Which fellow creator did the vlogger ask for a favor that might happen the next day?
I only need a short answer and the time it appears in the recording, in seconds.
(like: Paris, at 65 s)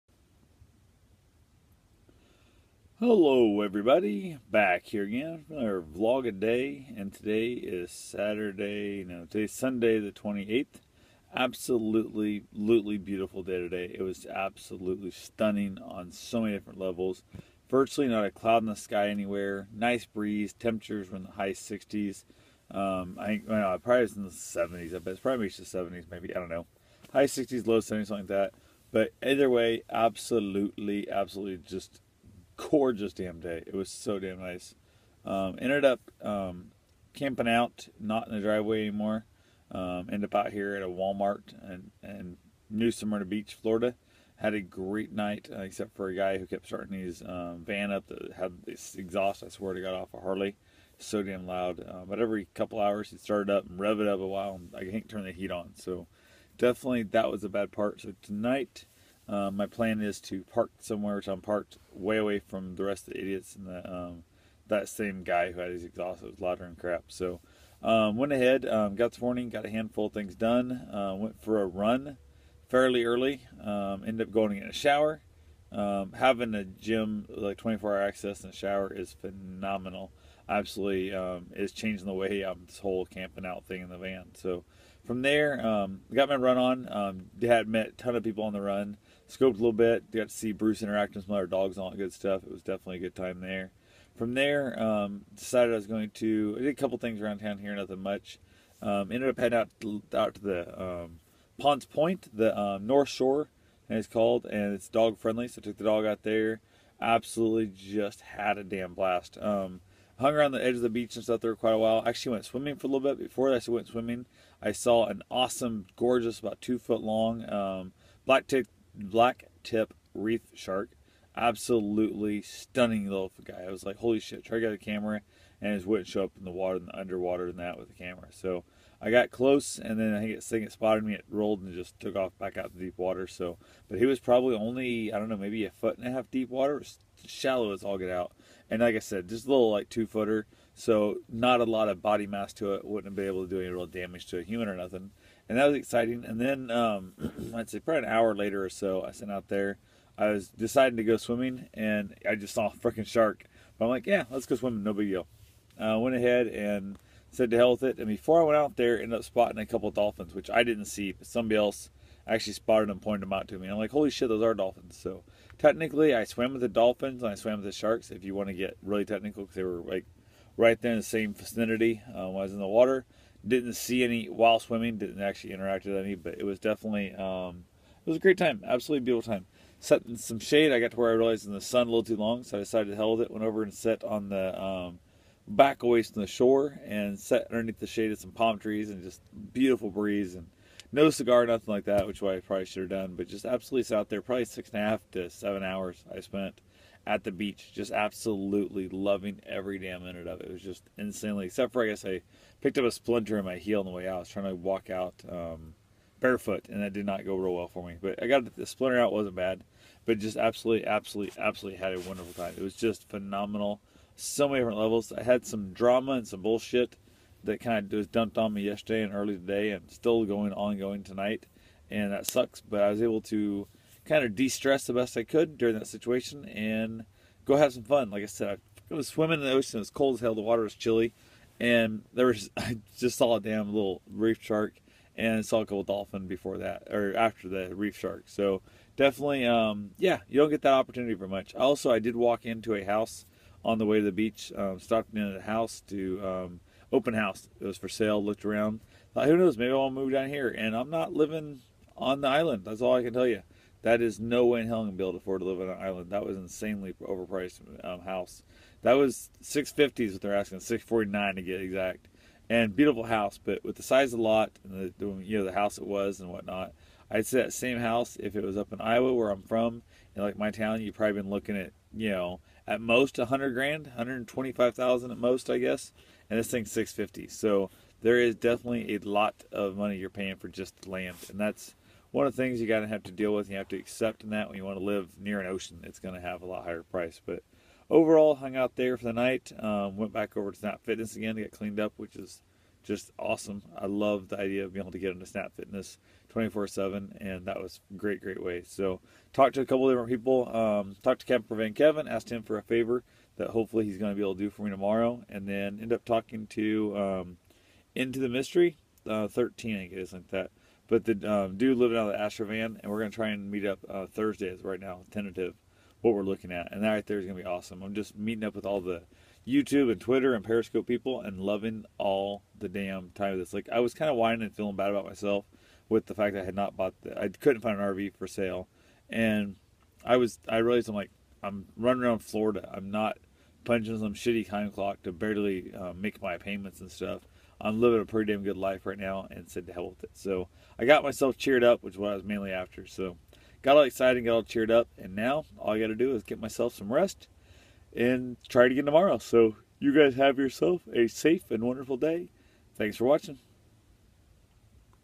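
Camper Van Kevin, at 301 s.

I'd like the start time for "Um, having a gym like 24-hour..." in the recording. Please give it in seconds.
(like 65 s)
75 s.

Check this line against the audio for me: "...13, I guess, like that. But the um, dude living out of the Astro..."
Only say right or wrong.
right.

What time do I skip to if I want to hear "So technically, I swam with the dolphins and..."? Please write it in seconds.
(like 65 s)
165 s.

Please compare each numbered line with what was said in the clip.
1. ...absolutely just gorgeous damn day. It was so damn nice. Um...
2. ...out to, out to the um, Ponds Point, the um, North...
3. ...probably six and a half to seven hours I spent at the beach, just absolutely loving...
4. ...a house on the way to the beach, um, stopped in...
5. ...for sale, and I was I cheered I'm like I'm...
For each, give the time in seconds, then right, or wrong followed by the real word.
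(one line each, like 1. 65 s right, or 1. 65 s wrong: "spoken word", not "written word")
1. 31 s right
2. 99 s right
3. 194 s right
4. 242 s right
5. 328 s wrong: "realized", not "cheered".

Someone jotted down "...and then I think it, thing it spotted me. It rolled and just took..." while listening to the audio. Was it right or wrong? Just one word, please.
right.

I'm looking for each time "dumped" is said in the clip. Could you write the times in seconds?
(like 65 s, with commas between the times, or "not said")
218 s.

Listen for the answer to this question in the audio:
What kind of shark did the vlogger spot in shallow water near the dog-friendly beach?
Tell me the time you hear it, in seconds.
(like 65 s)
118 s.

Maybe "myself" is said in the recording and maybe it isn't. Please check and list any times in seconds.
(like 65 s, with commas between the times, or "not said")
325 s, 341 s, 346 s.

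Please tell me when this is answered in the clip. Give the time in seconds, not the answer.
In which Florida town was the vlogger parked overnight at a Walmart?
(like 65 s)
42 s.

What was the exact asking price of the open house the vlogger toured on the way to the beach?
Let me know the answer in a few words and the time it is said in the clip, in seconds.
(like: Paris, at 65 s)
$649,000, at 260 s.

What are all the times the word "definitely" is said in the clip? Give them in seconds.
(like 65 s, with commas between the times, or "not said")
56 s, 92 s, 176 s, 238 s, 278 s.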